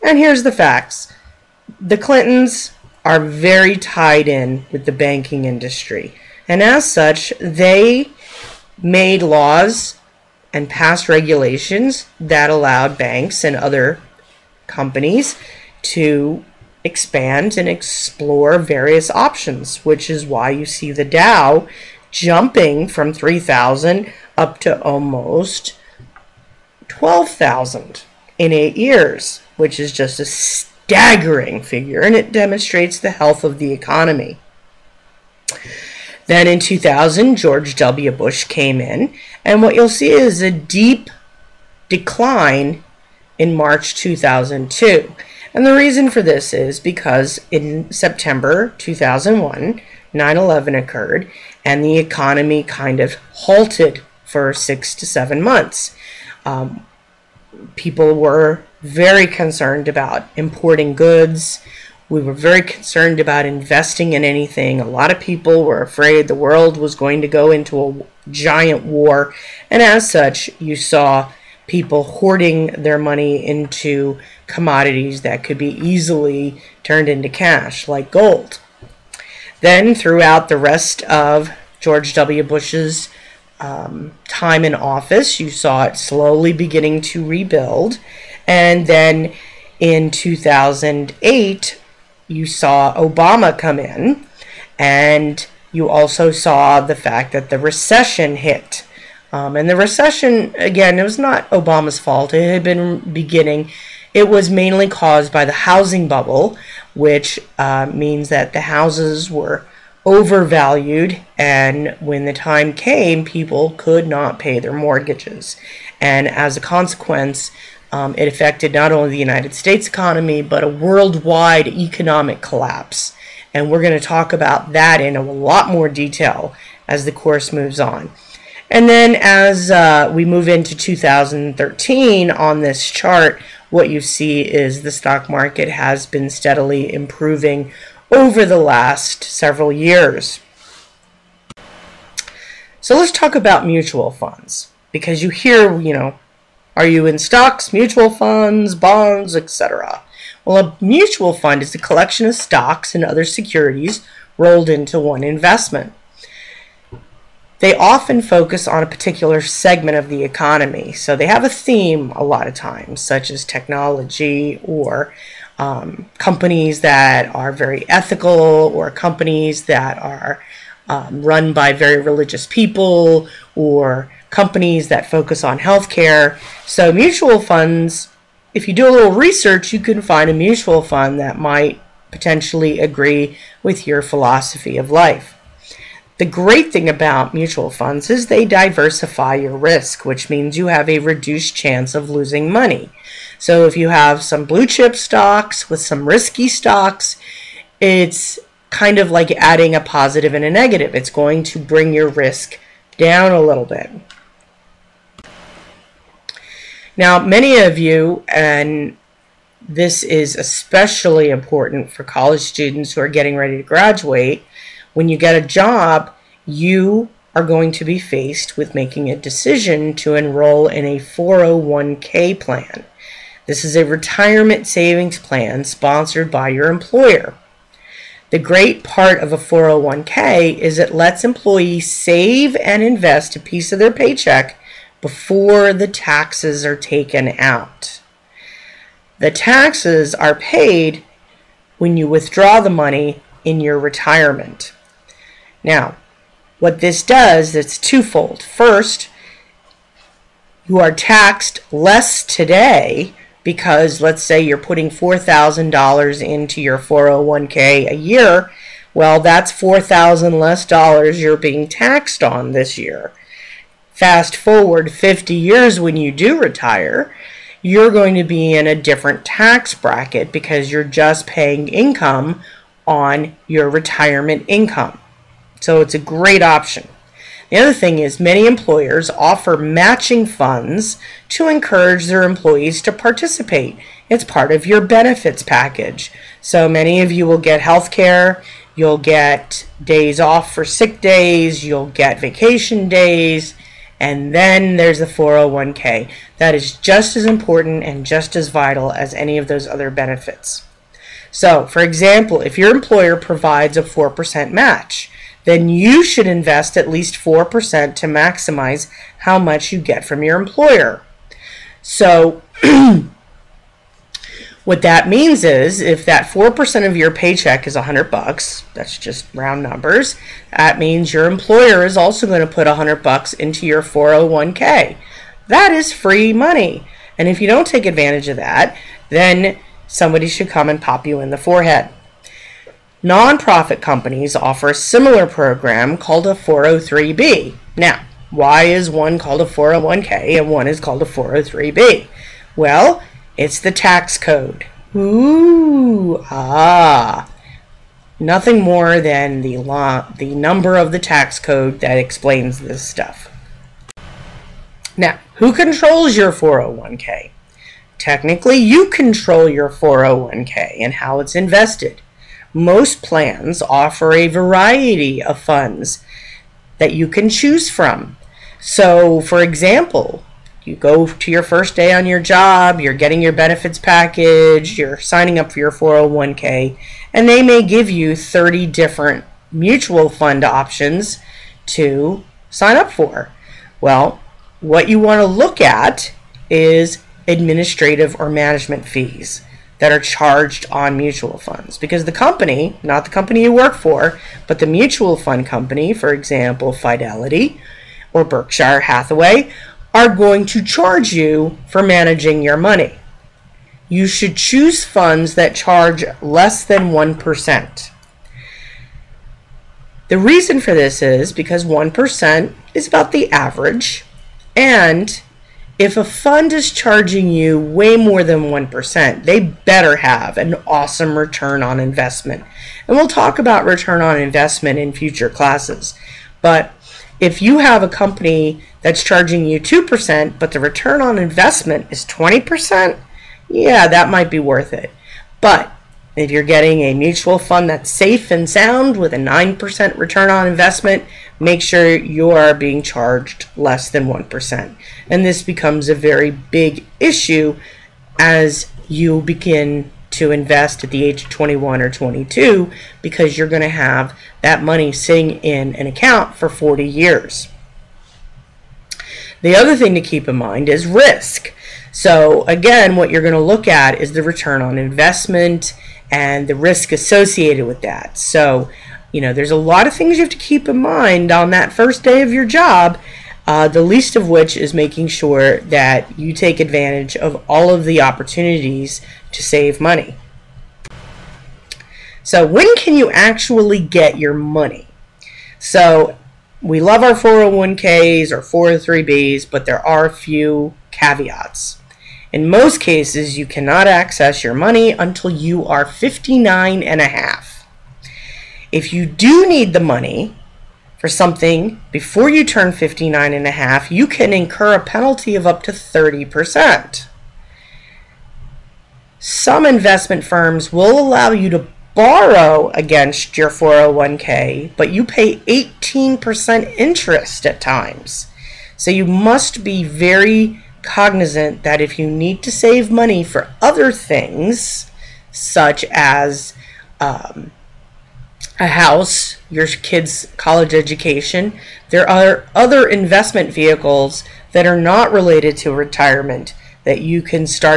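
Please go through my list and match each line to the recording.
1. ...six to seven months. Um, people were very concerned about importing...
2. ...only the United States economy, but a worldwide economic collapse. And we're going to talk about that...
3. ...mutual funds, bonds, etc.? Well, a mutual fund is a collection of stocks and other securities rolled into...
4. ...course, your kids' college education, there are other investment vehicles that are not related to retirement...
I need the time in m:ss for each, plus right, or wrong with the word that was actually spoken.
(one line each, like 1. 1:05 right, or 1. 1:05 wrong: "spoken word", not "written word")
1. 0:54 right
2. 1:58 right
3. 2:27 right
4. 8:48 wrong: "house", not "course".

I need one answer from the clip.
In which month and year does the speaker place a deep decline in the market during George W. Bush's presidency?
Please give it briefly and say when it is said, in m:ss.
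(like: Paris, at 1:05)
March 2002, at 0:43.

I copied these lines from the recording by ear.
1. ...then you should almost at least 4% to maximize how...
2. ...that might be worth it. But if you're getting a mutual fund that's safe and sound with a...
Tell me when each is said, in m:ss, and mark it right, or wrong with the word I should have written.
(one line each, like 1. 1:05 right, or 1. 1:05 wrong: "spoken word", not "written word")
1. 5:05 wrong: "invest", not "almost"
2. 7:13 right.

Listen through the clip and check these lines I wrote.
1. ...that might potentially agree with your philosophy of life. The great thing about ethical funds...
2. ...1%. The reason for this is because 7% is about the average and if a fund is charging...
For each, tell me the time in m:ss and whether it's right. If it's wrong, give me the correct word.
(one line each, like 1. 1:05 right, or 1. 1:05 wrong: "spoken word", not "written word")
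1. 3:01 wrong: "mutual", not "ethical"
2. 6:46 wrong: "1", not "7".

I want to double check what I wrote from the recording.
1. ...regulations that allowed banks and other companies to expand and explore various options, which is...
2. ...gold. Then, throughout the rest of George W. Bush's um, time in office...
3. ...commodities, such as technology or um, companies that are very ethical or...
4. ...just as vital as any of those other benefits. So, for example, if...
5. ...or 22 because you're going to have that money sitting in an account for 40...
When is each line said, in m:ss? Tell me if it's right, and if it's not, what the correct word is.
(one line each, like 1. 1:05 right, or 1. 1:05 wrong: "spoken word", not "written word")
1. 0:11 right
2. 1:18 right
3. 2:42 wrong: "times", not "commodities"
4. 4:58 right
5. 7:31 right.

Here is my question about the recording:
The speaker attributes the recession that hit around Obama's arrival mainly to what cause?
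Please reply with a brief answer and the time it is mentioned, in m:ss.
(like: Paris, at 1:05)
the housing bubble, at 1:45.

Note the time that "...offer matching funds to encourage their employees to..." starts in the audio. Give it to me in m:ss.
4:39.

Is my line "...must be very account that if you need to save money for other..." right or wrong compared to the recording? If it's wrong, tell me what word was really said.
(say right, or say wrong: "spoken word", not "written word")
wrong: "cognizant", not "account".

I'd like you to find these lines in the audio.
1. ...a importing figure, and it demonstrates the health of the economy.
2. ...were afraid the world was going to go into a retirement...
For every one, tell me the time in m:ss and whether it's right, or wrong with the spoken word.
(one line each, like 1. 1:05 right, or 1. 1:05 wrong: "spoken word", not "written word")
1. 0:30 wrong: "staggering", not "importing"
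2. 1:05 wrong: "giant", not "retirement".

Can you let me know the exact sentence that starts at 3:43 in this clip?
This is a retirement savings plan sponsored by your employer.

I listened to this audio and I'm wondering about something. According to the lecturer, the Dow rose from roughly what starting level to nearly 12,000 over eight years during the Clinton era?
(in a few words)
3,000.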